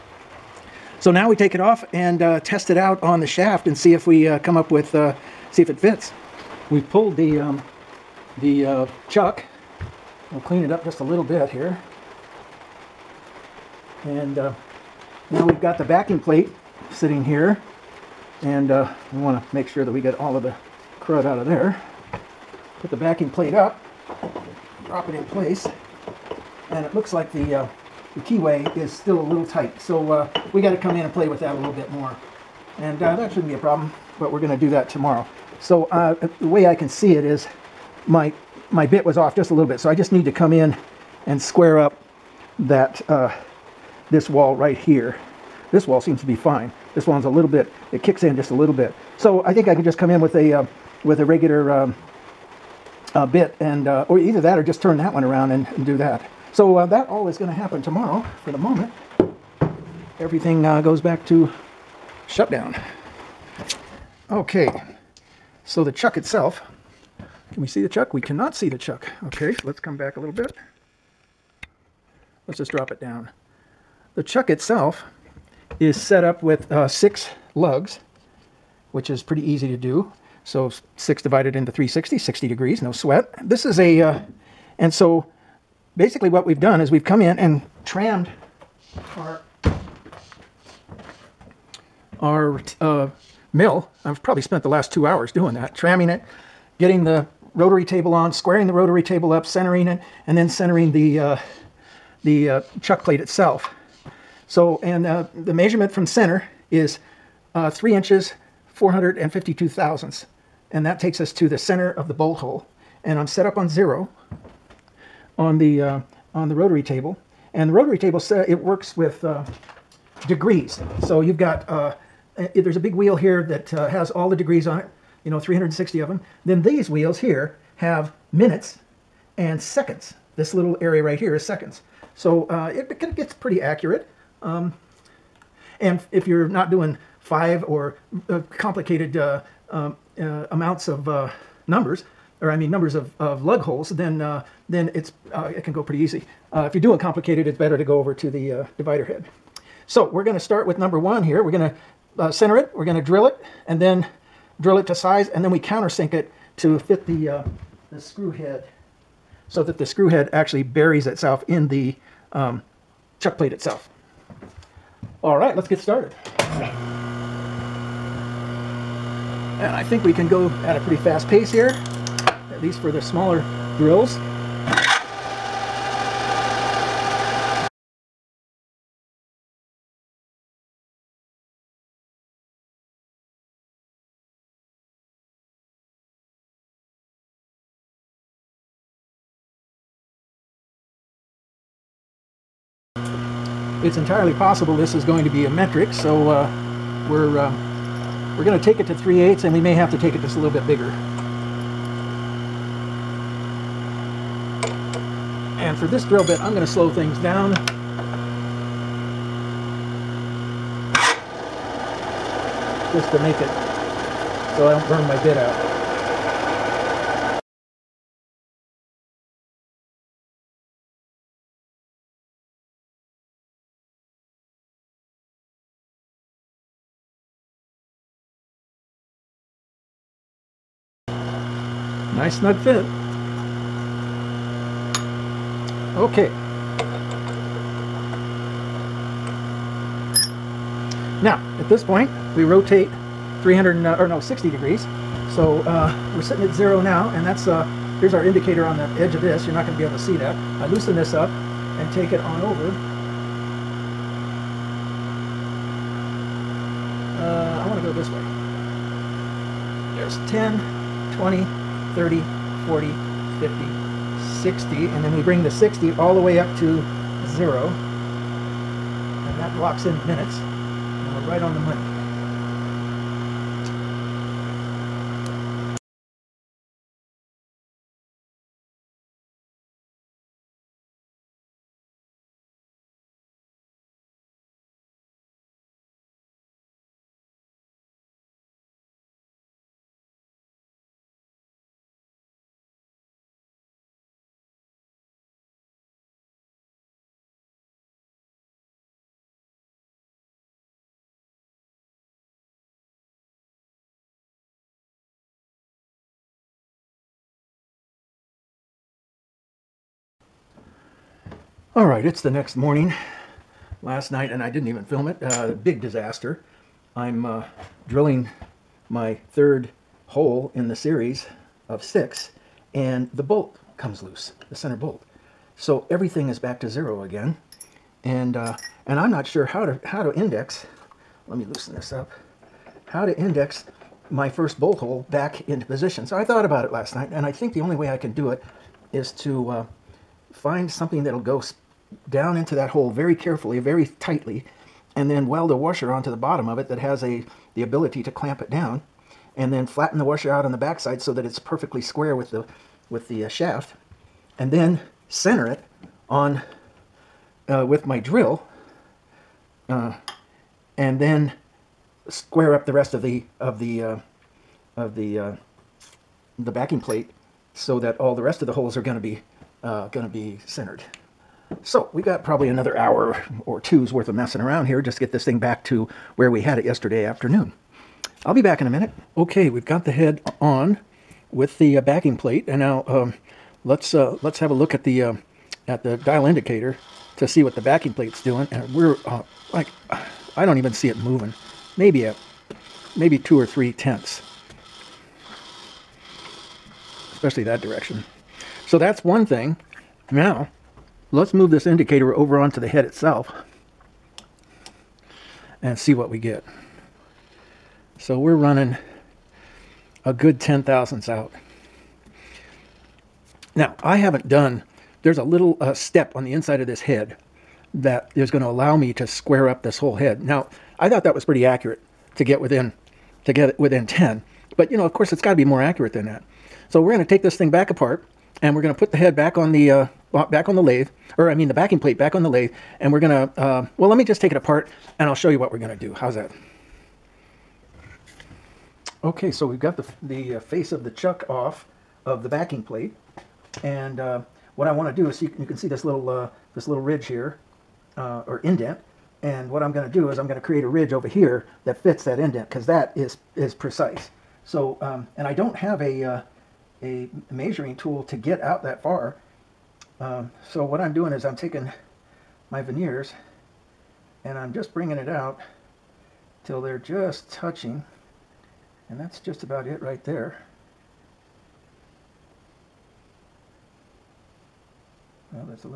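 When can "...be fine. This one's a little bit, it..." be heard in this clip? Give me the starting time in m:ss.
0:46.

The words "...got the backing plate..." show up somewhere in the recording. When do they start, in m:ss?
0:15.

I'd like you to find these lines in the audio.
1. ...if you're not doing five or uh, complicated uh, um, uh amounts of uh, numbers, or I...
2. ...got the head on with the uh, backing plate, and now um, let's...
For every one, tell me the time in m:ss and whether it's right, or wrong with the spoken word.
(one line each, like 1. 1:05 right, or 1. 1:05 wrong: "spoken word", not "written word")
1. 2:16 right
2. 6:19 right.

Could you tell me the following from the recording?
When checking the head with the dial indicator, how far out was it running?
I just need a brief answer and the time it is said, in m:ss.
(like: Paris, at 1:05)
10 thousandths, at 6:50.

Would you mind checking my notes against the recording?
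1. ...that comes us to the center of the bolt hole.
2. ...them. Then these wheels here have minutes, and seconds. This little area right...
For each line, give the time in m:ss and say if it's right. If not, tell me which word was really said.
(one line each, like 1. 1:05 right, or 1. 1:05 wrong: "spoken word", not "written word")
1. 1:50 wrong: "takes", not "comes"
2. 2:06 right.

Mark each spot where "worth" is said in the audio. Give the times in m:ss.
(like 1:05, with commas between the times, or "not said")
6:13.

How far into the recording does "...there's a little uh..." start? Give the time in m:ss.
6:55.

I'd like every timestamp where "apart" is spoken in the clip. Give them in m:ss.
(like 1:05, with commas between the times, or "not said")
7:07, 7:14.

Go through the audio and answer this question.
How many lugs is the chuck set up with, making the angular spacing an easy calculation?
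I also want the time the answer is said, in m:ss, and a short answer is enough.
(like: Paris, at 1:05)
6, at 1:16.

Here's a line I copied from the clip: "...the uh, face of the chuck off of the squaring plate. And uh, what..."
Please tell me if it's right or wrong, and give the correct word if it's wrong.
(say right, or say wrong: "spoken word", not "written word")
wrong: "backing", not "squaring".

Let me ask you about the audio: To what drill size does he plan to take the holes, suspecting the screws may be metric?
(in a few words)
3/8.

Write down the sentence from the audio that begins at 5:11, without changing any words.
All right, it's the next morning.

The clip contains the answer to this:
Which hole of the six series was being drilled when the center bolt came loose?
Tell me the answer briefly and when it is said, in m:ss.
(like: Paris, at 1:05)
third, at 5:19.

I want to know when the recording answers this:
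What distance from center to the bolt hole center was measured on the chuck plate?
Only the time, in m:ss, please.
1:47.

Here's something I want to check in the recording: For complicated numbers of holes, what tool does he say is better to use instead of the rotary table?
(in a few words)
divider head.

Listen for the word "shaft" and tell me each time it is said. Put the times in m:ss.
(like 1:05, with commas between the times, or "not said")
0:03, 5:53.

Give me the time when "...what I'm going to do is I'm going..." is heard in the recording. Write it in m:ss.
7:29.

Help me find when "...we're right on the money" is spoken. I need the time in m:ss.
4:31.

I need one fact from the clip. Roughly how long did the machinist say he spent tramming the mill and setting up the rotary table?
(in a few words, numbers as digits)
2 hours.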